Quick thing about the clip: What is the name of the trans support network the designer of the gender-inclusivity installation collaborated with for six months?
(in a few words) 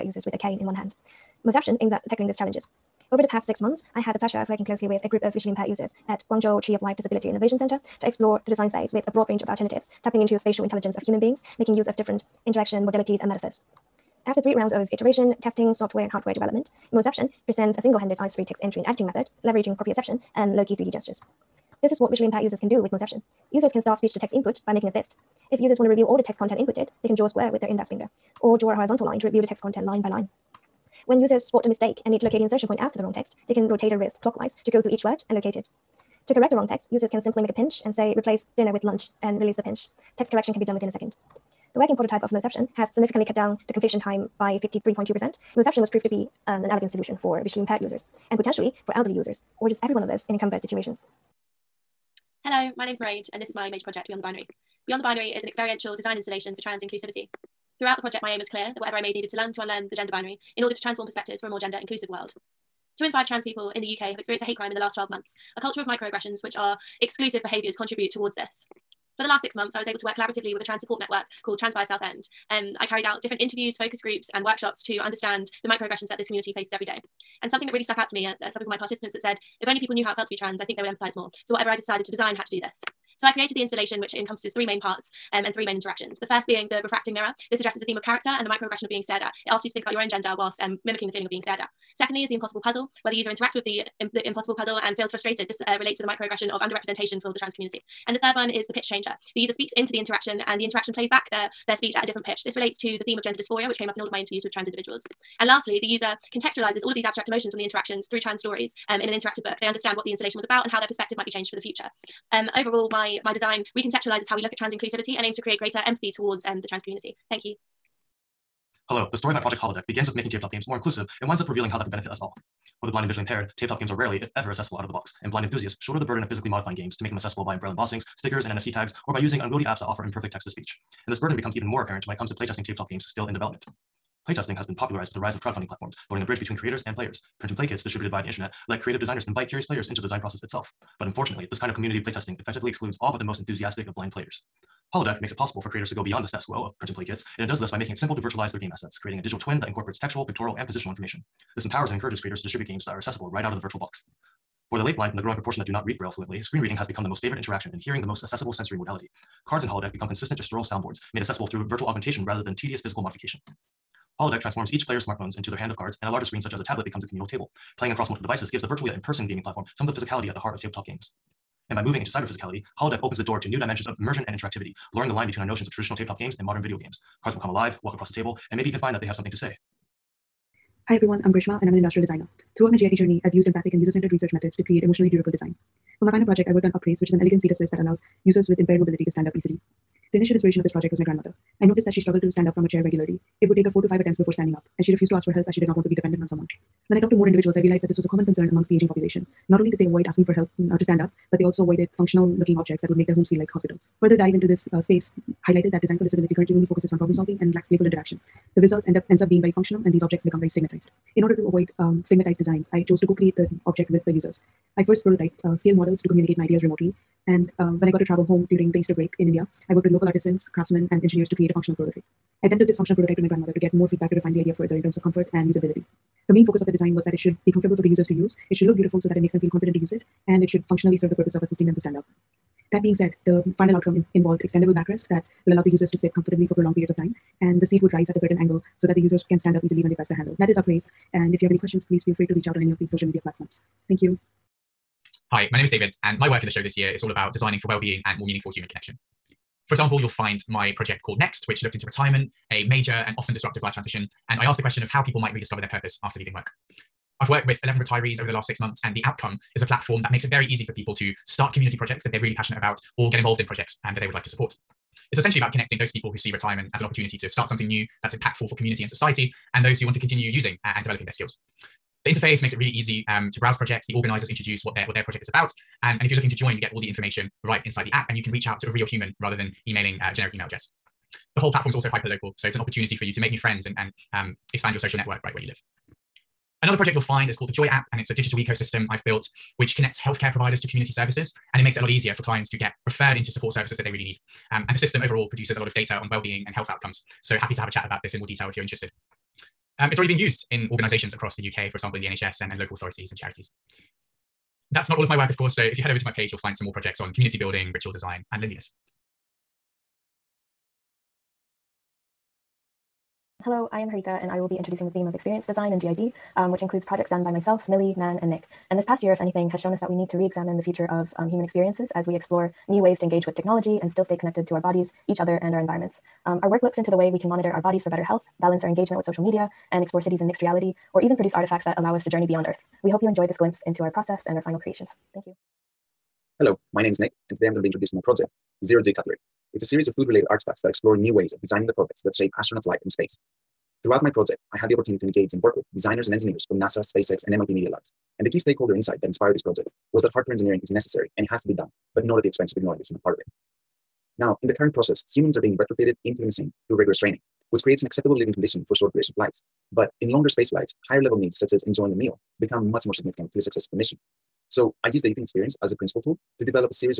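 Transpire Southend.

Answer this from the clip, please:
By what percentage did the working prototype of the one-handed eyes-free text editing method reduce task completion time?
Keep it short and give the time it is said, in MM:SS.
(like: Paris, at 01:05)
53.2%, at 00:44.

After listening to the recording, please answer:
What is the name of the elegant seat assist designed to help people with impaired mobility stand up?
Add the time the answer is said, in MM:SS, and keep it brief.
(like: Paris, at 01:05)
Upraise, at 03:06.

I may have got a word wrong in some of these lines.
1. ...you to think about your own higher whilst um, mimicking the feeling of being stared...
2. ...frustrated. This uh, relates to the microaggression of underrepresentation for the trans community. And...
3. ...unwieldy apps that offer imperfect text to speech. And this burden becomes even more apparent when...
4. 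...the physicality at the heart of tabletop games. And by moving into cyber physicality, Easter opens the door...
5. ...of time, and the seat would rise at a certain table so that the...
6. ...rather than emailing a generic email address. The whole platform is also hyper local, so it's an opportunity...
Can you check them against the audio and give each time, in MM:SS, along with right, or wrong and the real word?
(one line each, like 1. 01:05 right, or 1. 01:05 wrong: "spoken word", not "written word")
1. 01:29 wrong: "gender", not "higher"
2. 01:35 right
3. 02:09 right
4. 02:49 wrong: "Holodeck", not "Easter"
5. 03:56 wrong: "angle", not "table"
6. 04:39 right.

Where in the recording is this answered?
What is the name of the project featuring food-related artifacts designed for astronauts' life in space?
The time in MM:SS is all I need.
05:38.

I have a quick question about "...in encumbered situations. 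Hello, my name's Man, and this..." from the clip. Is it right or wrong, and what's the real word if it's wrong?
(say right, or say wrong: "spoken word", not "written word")
wrong: "Mairead", not "Man".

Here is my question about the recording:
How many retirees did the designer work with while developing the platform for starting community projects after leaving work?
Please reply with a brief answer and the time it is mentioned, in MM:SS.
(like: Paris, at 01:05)
11, at 04:17.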